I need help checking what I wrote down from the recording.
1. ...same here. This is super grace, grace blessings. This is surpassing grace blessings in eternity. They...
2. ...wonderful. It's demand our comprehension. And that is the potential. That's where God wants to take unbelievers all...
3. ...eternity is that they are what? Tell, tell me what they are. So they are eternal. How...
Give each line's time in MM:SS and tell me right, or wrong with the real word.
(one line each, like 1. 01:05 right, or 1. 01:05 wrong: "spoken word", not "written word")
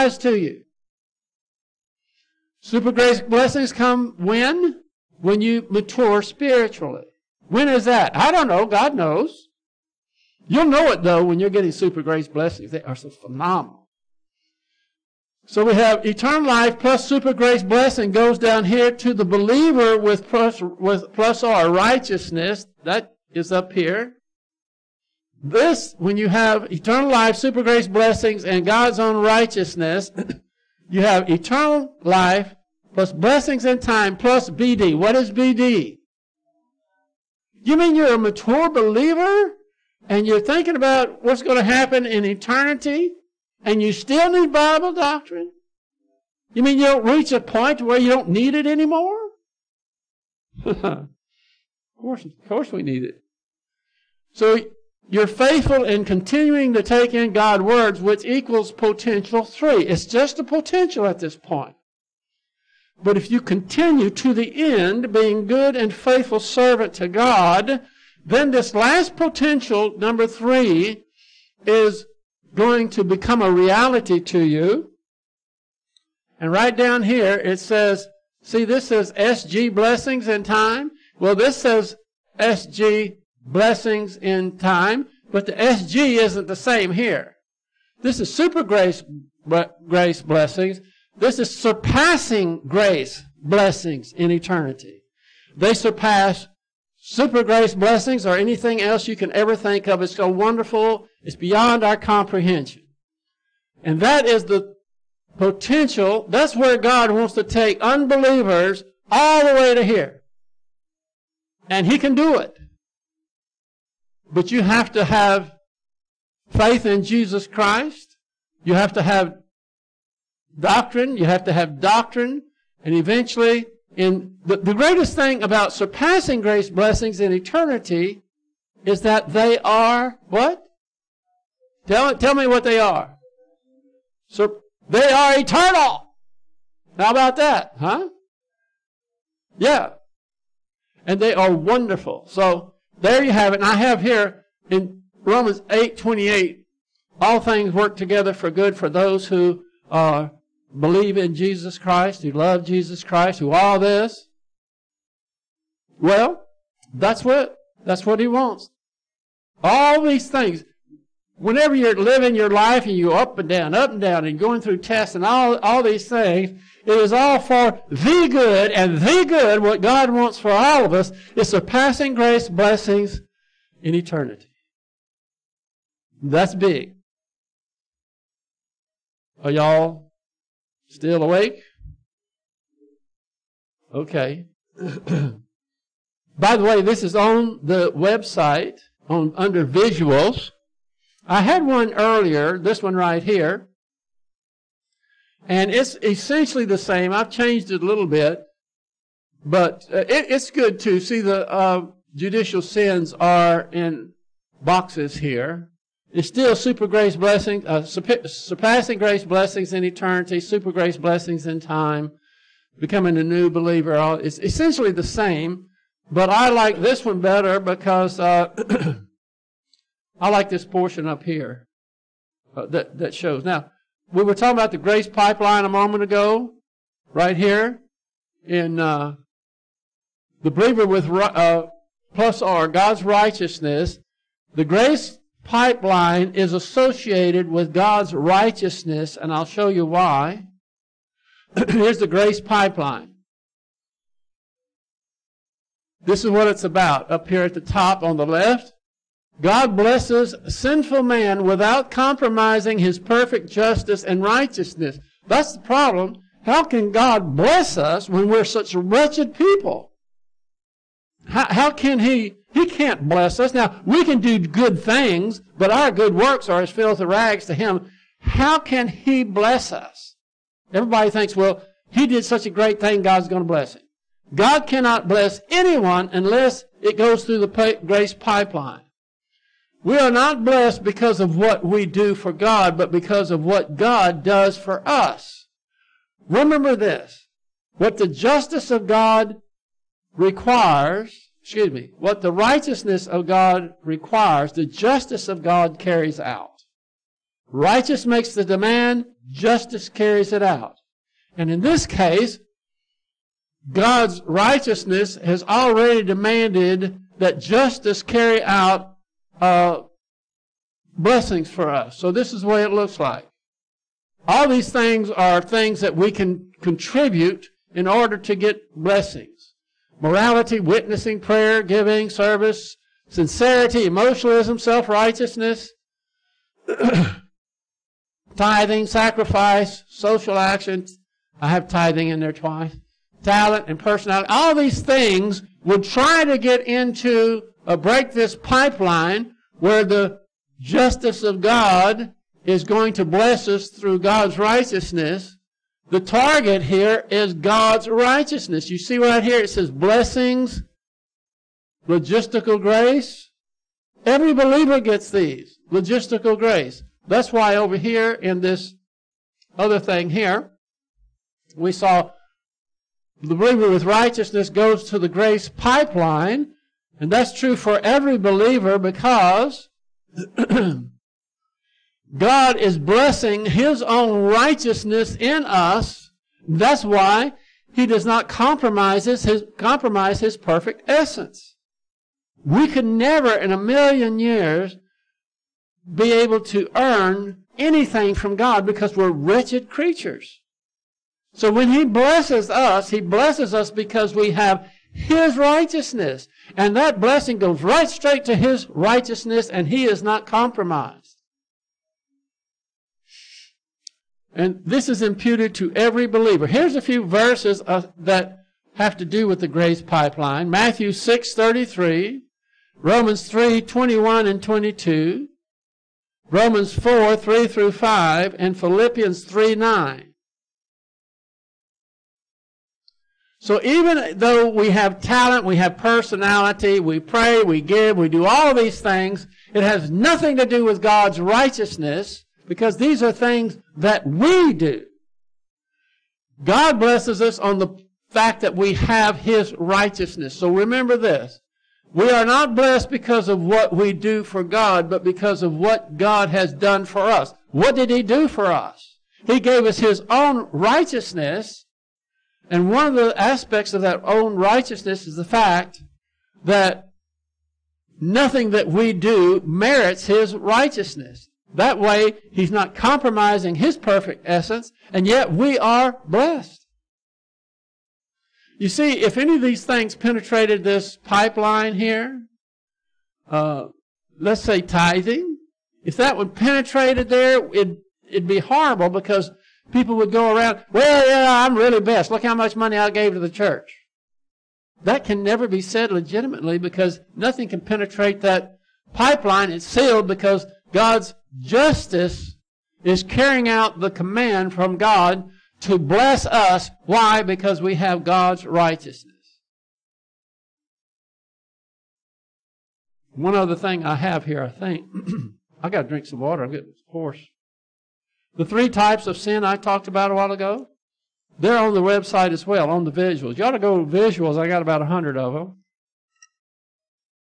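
1. 01:26 right
2. 01:40 wrong: "beyond", not "demand"
3. 02:07 right.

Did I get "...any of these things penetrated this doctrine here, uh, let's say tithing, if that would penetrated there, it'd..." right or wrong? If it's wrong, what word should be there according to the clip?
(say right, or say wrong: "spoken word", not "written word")
wrong: "pipeline", not "doctrine".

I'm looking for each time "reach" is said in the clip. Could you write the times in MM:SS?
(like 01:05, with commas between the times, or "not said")
00:47.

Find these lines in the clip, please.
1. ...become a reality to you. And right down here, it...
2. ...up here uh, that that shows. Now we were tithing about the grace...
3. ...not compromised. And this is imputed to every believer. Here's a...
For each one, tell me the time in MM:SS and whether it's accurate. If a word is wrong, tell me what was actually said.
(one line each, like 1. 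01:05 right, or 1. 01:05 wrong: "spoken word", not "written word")
1. 01:13 right
2. 03:41 wrong: "talking", not "tithing"
3. 06:40 right.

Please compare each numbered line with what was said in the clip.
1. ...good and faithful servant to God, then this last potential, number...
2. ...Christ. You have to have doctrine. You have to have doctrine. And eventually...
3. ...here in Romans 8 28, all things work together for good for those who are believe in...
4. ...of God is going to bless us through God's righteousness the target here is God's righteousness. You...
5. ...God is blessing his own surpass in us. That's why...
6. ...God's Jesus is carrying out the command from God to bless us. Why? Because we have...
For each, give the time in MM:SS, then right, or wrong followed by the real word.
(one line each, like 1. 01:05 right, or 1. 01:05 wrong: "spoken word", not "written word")
1. 01:05 right
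2. 01:57 right
3. 02:24 right
4. 05:41 right
5. 06:12 wrong: "righteousness", not "surpass"
6. 08:10 wrong: "Justice", not "Jesus".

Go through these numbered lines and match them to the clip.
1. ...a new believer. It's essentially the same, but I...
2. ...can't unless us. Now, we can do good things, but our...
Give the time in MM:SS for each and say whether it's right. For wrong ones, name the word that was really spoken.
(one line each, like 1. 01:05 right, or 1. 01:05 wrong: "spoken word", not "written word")
1. 03:33 right
2. 04:22 wrong: "bless", not "unless".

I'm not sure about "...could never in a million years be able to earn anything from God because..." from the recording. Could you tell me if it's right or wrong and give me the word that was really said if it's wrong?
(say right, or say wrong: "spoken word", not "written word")
right.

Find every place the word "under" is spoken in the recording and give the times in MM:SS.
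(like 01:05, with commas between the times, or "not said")
03:09.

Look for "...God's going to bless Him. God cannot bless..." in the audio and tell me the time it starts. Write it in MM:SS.
04:33.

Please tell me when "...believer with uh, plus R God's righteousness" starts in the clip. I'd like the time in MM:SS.
03:50.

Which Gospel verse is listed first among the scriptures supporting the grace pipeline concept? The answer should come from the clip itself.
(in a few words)
Matthew 6:33.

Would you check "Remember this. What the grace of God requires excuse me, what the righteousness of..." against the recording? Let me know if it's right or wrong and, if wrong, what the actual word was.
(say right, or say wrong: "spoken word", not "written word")
wrong: "justice", not "grace".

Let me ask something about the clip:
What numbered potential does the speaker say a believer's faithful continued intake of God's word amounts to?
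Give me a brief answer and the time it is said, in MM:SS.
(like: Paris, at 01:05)
Potential three, at 00:58.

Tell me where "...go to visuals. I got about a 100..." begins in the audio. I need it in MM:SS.
08:33.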